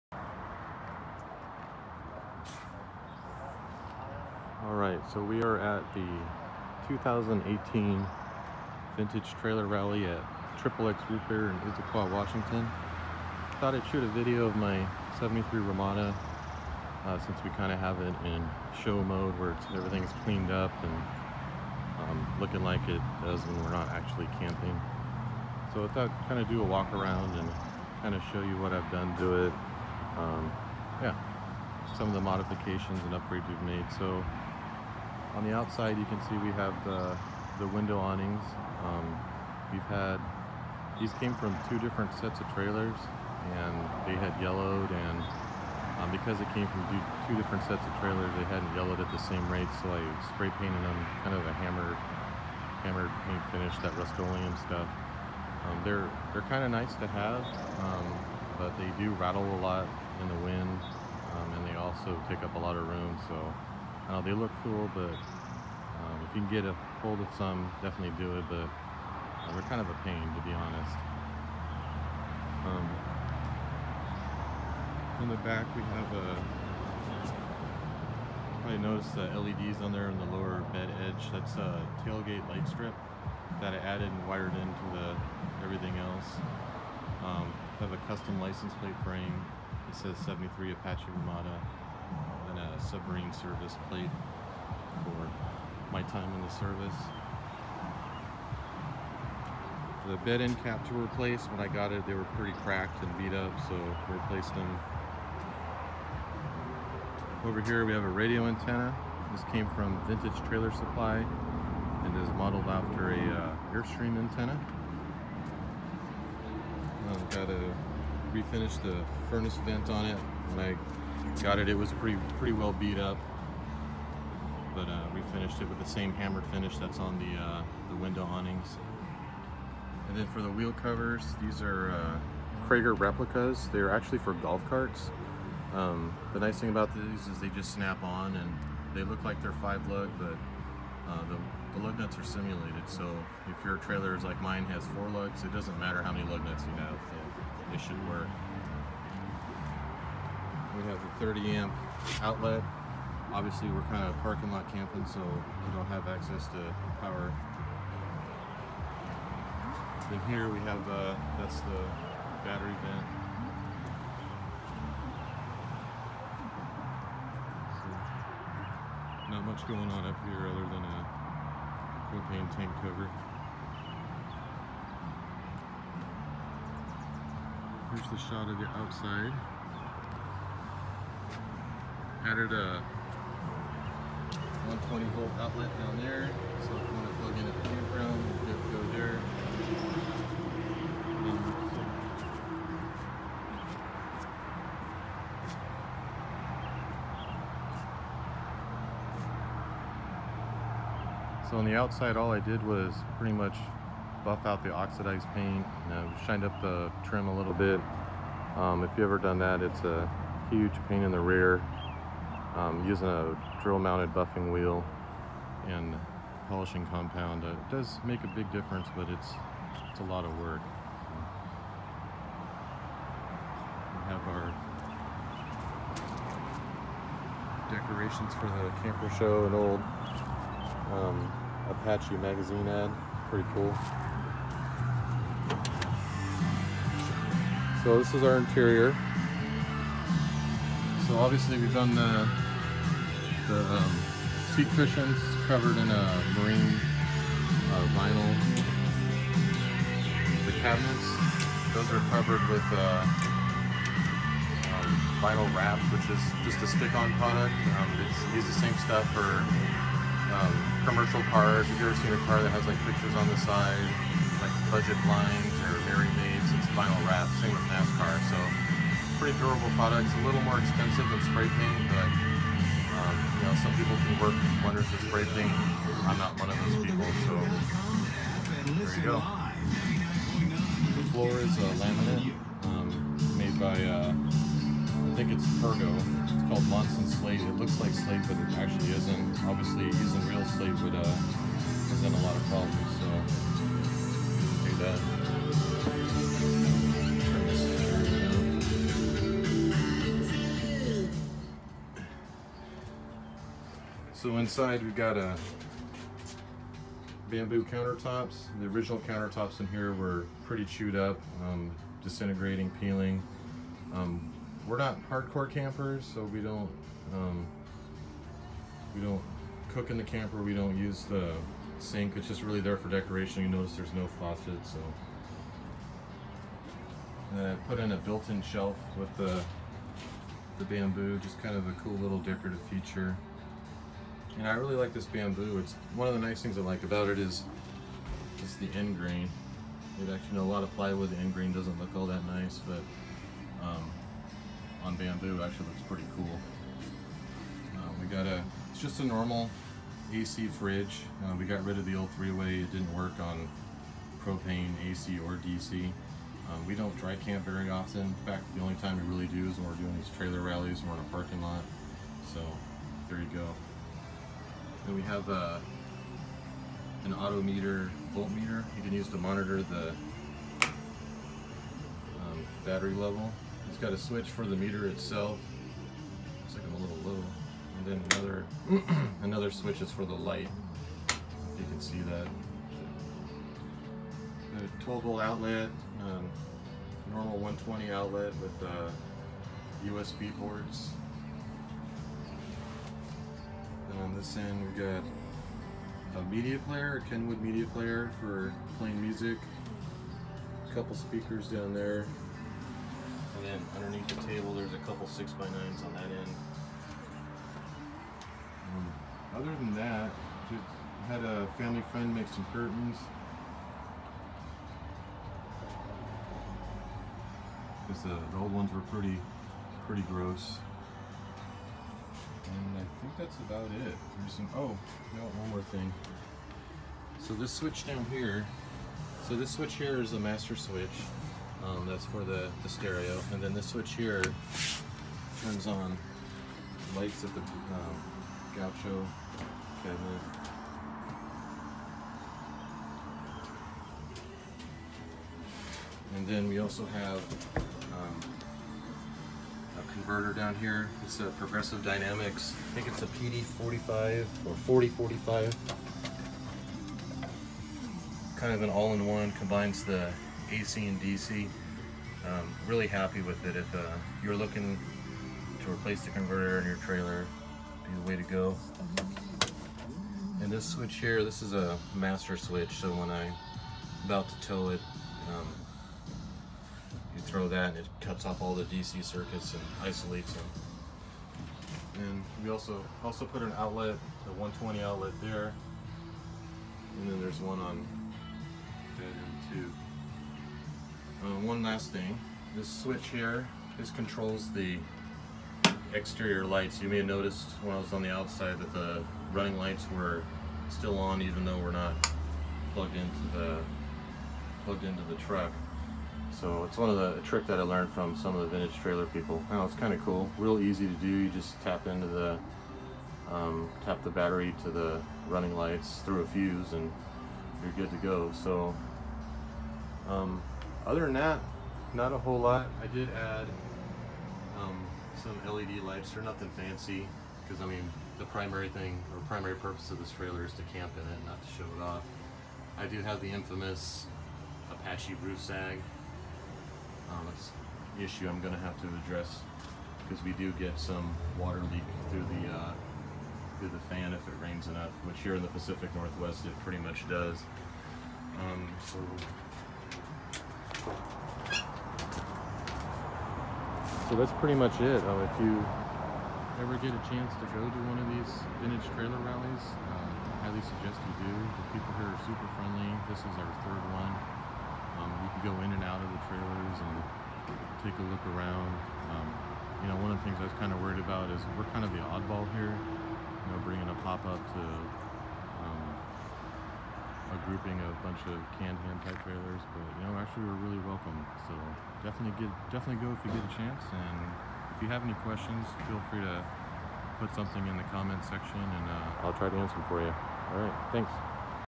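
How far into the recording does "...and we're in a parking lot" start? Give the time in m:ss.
6:00.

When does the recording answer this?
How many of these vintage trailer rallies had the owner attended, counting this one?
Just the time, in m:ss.
9:23.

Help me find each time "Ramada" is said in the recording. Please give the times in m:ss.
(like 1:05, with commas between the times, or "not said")
0:15, 1:31.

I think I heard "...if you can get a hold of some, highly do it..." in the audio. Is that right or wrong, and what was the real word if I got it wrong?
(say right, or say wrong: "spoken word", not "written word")
wrong: "definitely", not "highly".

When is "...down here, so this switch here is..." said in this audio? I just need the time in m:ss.
7:07.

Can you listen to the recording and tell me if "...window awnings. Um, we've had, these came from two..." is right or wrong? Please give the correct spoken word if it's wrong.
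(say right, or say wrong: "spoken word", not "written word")
right.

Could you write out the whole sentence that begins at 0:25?
So I thought kind of do a walk around and kind of show you what I've done to it.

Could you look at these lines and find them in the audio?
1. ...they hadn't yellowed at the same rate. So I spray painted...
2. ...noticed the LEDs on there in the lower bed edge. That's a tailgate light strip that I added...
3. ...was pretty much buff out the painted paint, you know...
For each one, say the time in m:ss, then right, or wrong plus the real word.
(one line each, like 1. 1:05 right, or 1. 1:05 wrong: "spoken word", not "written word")
1. 0:48 right
2. 1:18 right
3. 3:22 wrong: "oxidized", not "painted".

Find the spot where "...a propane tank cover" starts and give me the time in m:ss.
2:50.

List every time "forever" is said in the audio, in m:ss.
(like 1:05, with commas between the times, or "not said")
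not said.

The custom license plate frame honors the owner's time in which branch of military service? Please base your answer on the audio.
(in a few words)
submarine service.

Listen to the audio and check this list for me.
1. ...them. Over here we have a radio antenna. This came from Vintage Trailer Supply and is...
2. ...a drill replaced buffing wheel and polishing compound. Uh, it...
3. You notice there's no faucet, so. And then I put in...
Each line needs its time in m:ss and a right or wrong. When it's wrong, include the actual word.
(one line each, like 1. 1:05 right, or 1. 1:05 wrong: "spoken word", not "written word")
1. 1:44 right
2. 3:33 wrong: "mounted", not "replaced"
3. 5:23 right.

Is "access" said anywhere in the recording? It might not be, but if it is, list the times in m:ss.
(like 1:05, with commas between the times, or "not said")
2:36.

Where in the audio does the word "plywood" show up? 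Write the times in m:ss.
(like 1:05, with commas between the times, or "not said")
5:40.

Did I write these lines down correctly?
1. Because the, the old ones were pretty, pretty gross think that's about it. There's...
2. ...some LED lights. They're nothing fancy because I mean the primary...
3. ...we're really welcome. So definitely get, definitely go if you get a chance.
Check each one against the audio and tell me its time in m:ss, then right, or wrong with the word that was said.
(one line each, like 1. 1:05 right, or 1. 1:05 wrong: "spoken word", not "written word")
1. 6:57 right
2. 8:45 right
3. 9:40 right.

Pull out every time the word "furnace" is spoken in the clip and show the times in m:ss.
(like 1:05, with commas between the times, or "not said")
1:59.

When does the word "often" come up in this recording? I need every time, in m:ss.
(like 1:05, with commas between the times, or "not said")
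5:57.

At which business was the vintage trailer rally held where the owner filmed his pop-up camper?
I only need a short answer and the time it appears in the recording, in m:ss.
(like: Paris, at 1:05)
Triple X Root Beer, at 0:10.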